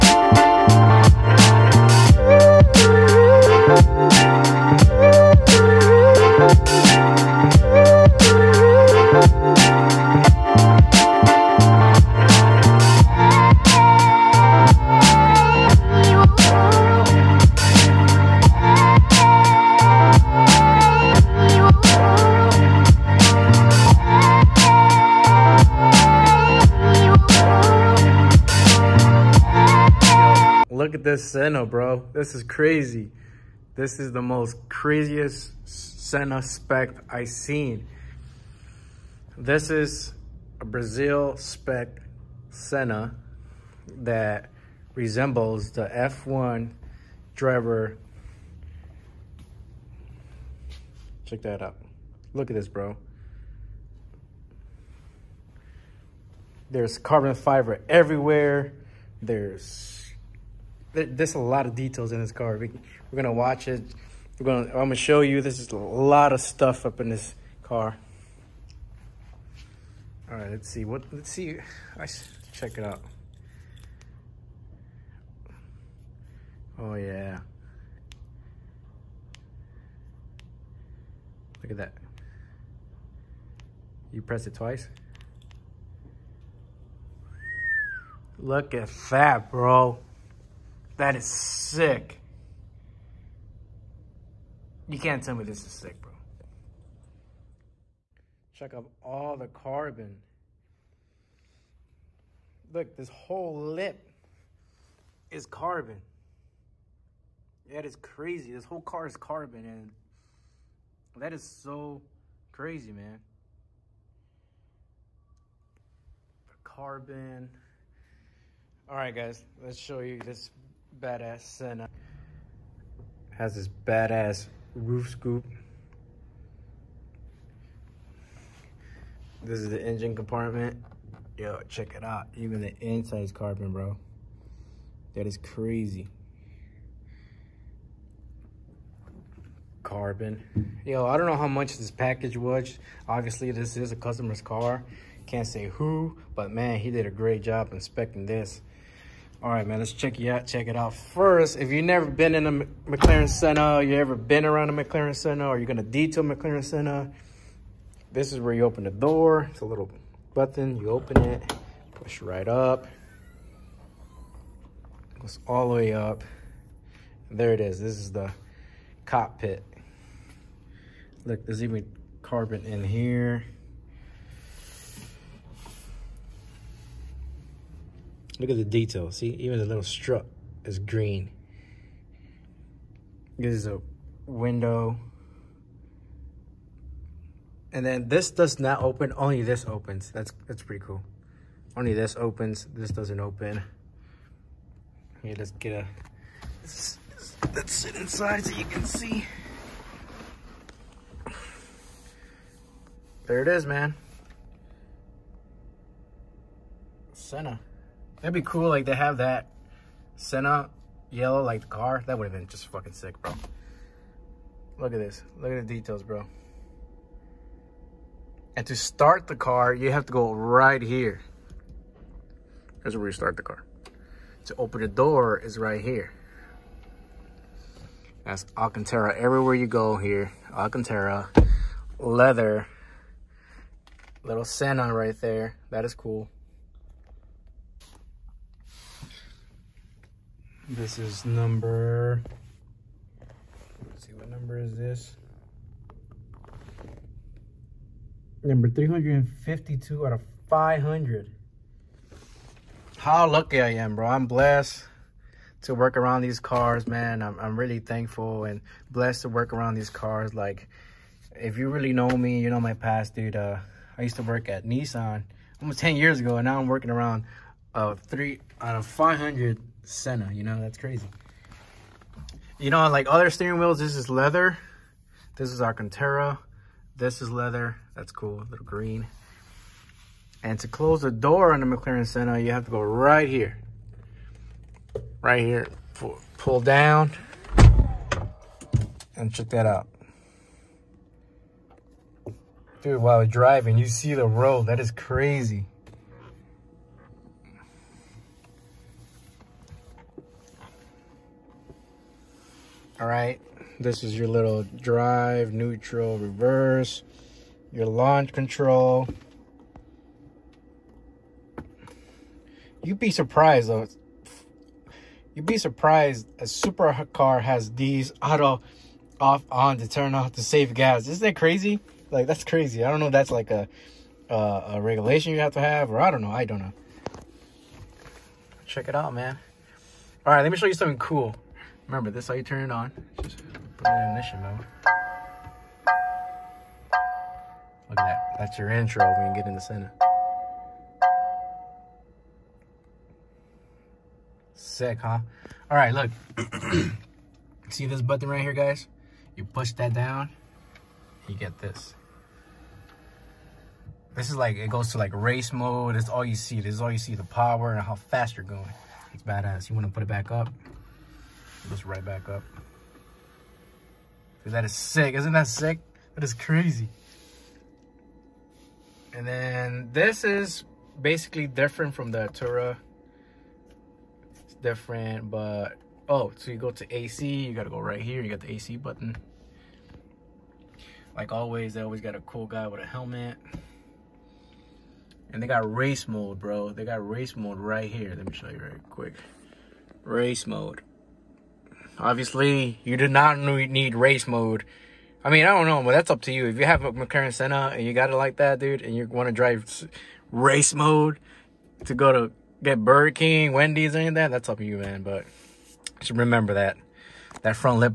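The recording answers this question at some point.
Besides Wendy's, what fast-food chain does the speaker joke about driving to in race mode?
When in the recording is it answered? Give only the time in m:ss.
6:42.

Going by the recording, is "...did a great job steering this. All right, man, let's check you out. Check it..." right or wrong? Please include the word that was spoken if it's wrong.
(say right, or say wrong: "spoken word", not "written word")
wrong: "inspecting", not "steering".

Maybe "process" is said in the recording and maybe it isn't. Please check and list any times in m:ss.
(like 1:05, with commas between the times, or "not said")
not said.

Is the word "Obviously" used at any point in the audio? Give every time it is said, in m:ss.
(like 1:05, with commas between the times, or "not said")
2:23, 6:31.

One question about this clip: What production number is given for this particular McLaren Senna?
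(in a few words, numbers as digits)
352.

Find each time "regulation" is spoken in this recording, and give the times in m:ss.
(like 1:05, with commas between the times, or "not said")
5:24.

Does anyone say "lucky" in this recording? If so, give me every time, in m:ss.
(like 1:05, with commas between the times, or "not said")
4:13.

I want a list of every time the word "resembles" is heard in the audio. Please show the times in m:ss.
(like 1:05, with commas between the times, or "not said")
0:44.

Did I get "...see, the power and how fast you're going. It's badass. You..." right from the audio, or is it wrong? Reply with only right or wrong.
right.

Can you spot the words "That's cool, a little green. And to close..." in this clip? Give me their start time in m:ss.
4:37.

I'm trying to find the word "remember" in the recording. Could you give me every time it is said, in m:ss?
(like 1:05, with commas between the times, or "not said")
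5:31, 6:46.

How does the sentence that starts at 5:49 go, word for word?
You push that down, you get this.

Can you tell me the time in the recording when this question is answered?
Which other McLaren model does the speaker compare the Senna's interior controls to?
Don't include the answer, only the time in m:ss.
6:12.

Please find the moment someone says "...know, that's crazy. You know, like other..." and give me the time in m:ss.
4:30.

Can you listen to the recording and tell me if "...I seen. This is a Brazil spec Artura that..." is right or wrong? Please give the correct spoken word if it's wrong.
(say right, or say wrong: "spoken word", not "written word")
wrong: "Senna", not "Artura".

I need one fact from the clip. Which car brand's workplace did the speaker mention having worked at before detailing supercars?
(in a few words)
Nissan.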